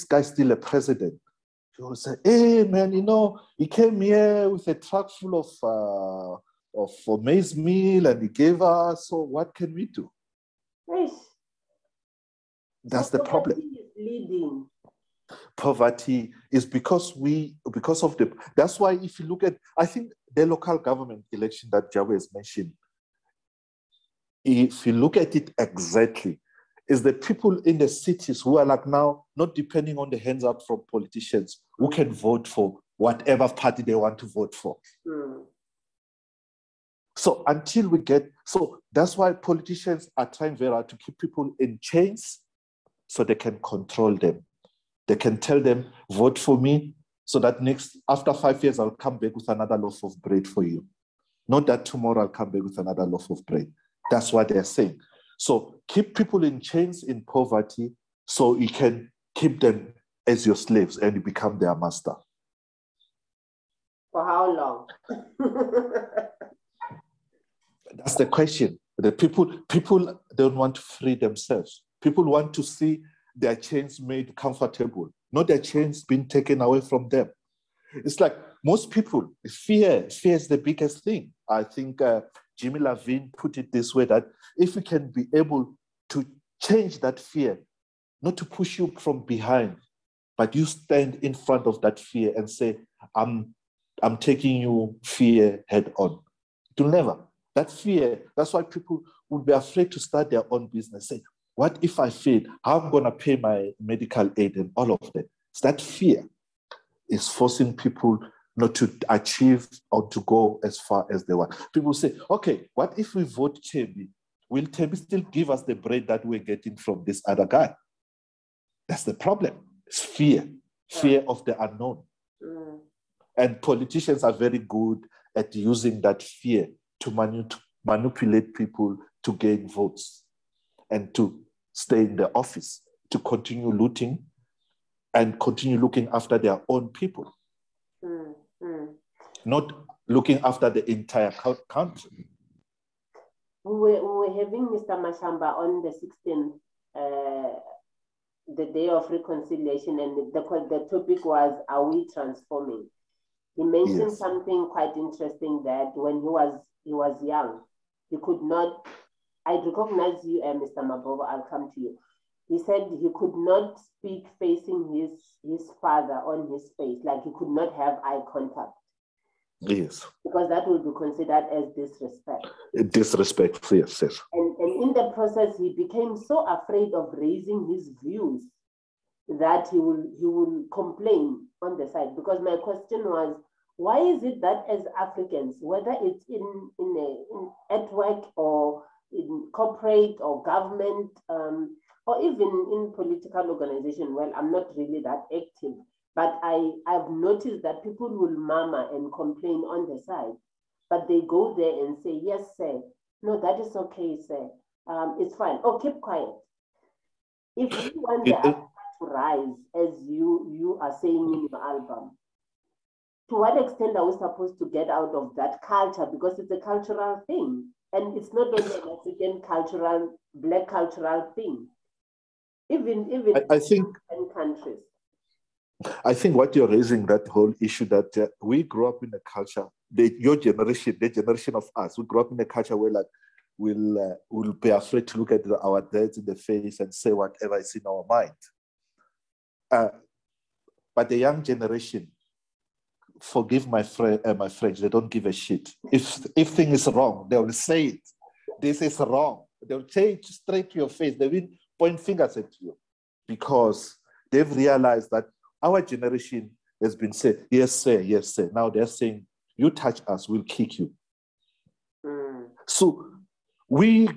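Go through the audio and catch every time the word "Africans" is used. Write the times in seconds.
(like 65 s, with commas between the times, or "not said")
184 s, 218 s.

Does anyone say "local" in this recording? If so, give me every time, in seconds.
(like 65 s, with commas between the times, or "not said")
20 s.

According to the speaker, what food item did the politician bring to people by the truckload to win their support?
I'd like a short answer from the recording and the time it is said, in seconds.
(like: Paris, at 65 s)
maize meal, at 7 s.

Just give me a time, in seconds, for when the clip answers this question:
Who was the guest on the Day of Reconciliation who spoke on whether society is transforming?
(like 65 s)
144 s.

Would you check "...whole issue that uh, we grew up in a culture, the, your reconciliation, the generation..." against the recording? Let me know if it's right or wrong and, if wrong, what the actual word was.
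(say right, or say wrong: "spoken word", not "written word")
wrong: "generation", not "reconciliation".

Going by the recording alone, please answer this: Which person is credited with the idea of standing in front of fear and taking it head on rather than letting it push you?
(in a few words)
Jimmy Levine.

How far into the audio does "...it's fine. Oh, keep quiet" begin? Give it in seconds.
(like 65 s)
205 s.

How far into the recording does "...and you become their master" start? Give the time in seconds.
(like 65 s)
60 s.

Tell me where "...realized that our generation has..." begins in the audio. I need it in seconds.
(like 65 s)
254 s.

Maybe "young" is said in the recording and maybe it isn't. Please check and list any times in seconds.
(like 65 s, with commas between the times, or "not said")
157 s, 241 s.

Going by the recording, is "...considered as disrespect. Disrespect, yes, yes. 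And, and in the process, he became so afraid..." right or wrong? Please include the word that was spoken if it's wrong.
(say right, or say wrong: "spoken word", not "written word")
right.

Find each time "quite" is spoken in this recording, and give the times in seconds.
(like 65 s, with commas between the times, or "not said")
154 s.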